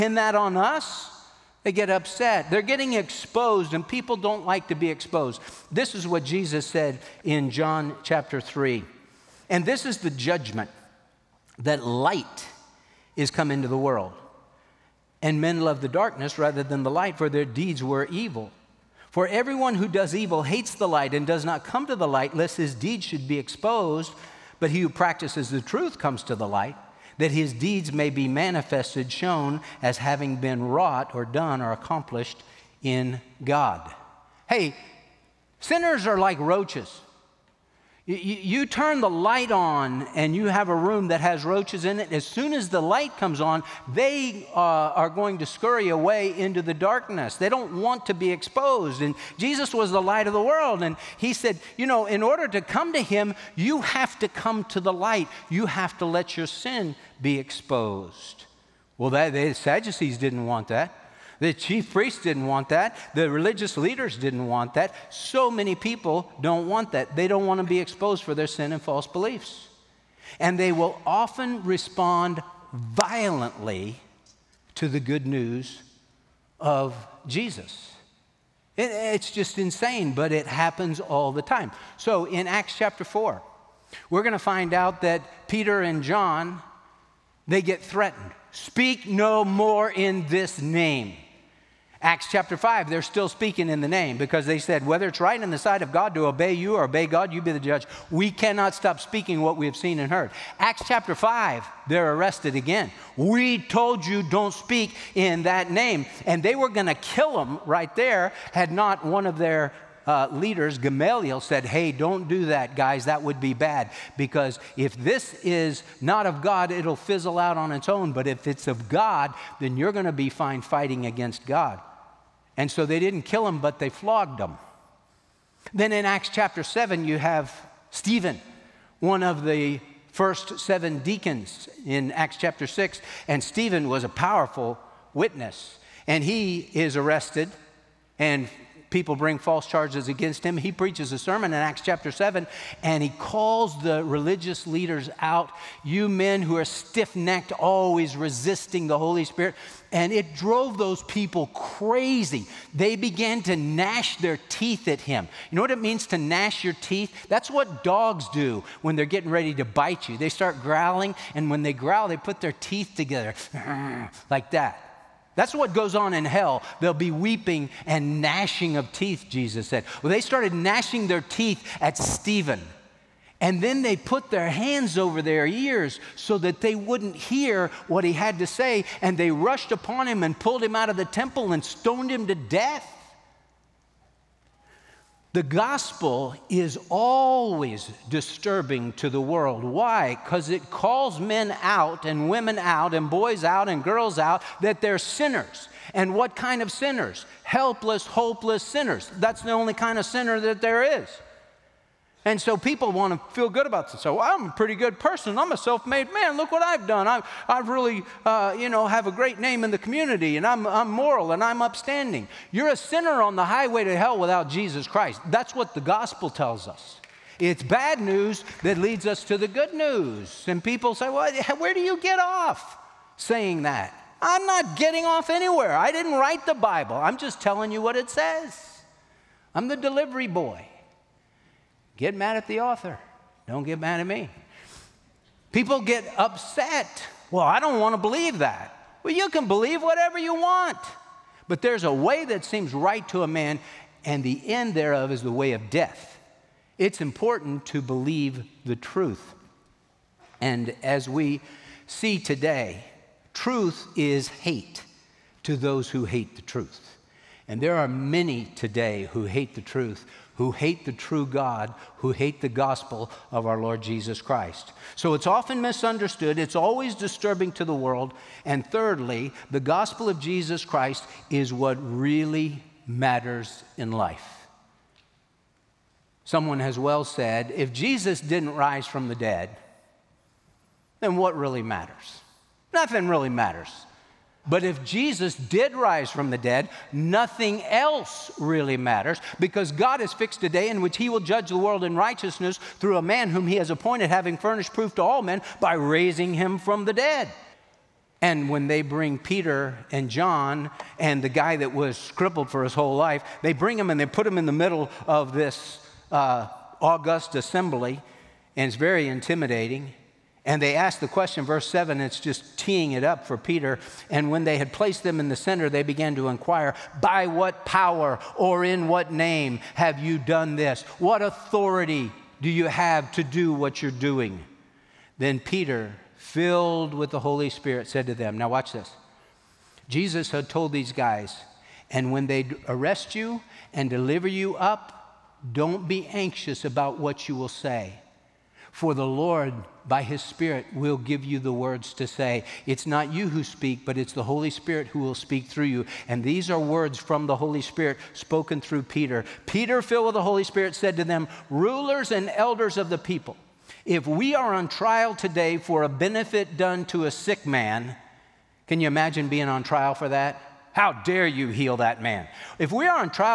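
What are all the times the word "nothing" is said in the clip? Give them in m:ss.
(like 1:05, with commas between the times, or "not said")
4:42, 4:46.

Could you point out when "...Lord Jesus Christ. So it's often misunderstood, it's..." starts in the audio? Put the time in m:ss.
4:23.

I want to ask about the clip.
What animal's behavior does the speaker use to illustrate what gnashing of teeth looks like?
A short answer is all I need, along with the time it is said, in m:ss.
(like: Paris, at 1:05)
Dogs, at 2:37.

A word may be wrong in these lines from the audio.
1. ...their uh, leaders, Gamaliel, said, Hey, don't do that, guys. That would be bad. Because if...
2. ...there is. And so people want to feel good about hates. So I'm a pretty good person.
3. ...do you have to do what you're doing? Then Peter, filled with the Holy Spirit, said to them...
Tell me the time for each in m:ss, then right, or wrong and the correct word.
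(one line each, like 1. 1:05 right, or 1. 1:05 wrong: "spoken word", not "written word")
1. 1:49 right
2. 3:20 wrong: "themselves", not "hates"
3. 5:22 right.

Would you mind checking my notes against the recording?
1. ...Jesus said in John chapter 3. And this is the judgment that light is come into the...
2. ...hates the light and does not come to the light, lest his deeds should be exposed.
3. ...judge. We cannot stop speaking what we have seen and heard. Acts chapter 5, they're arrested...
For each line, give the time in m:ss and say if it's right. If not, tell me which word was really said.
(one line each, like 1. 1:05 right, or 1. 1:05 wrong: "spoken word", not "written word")
1. 0:06 right
2. 0:20 right
3. 1:37 right.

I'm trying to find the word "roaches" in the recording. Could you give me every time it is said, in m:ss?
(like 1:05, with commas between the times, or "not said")
0:36, 0:41.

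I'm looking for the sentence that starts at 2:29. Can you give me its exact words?
And it drove those people crazy.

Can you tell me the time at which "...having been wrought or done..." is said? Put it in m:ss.
0:29.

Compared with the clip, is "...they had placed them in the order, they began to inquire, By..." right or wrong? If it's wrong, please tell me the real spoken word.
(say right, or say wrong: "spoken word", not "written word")
wrong: "center", not "order".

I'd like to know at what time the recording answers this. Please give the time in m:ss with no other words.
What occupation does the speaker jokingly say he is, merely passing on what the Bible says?
3:49.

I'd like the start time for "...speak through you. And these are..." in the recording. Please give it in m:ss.
5:45.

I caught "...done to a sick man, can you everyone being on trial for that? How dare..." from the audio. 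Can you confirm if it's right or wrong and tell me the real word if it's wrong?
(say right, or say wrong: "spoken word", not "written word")
wrong: "imagine", not "everyone".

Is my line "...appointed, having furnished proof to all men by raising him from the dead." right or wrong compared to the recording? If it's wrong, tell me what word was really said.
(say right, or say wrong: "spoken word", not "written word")
right.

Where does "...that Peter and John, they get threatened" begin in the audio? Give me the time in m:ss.
1:25.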